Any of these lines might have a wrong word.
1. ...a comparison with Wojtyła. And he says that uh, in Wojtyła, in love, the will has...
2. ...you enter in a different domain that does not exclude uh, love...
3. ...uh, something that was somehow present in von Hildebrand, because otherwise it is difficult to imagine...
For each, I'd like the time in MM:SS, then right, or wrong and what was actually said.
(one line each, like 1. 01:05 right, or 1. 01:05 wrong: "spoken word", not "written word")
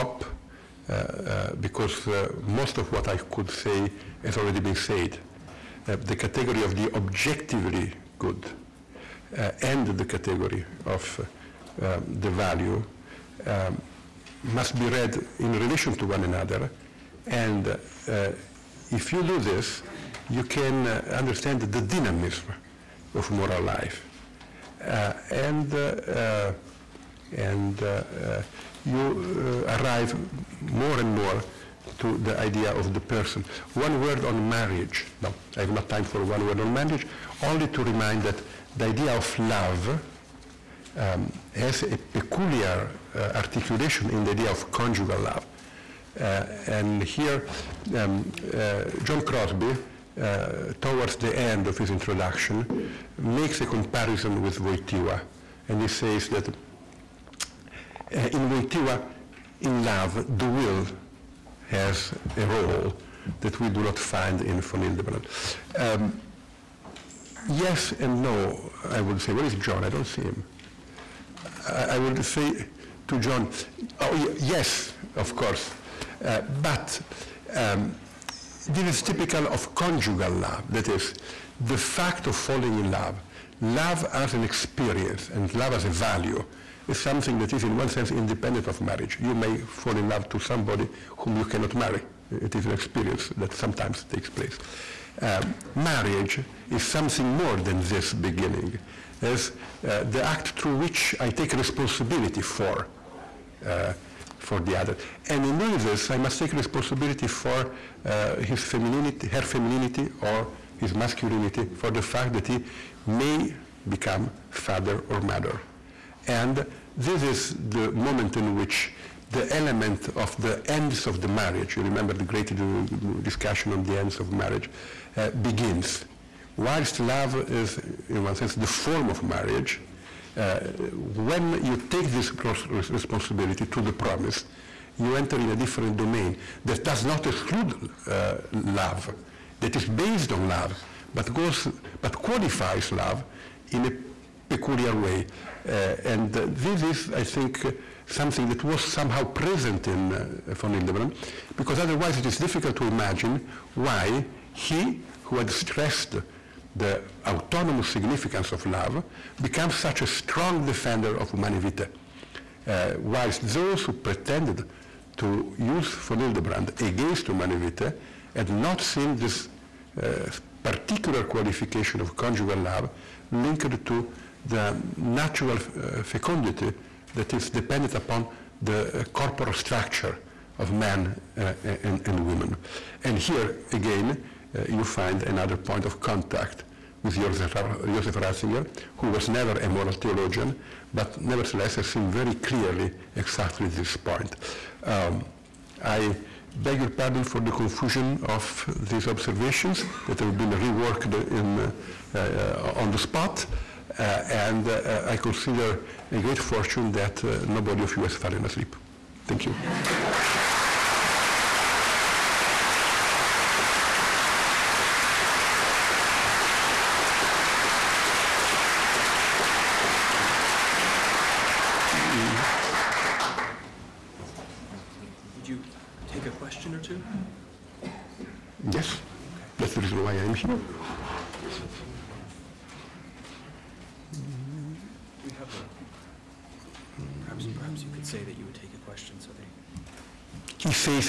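1. 00:53 right
2. 02:14 right
3. 02:27 right.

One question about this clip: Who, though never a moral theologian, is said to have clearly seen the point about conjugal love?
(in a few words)
Joseph Ratzinger.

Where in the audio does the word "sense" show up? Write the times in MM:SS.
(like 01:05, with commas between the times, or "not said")
01:27, 02:08.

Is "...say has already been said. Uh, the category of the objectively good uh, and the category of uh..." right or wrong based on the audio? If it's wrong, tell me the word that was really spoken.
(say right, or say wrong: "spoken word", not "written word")
right.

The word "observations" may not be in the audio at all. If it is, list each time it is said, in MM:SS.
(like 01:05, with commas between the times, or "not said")
03:19.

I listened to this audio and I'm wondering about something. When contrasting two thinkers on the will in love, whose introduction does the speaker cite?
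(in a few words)
John Crosby.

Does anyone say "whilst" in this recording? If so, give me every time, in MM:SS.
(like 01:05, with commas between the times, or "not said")
02:06, 02:43.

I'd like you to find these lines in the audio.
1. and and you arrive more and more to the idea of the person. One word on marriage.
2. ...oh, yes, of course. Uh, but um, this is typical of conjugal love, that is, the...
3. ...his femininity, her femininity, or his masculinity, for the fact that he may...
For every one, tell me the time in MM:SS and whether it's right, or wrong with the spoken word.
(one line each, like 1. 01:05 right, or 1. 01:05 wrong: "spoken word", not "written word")
1. 00:25 right
2. 01:14 right
3. 01:48 right.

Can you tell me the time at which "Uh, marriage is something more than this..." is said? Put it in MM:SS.
01:35.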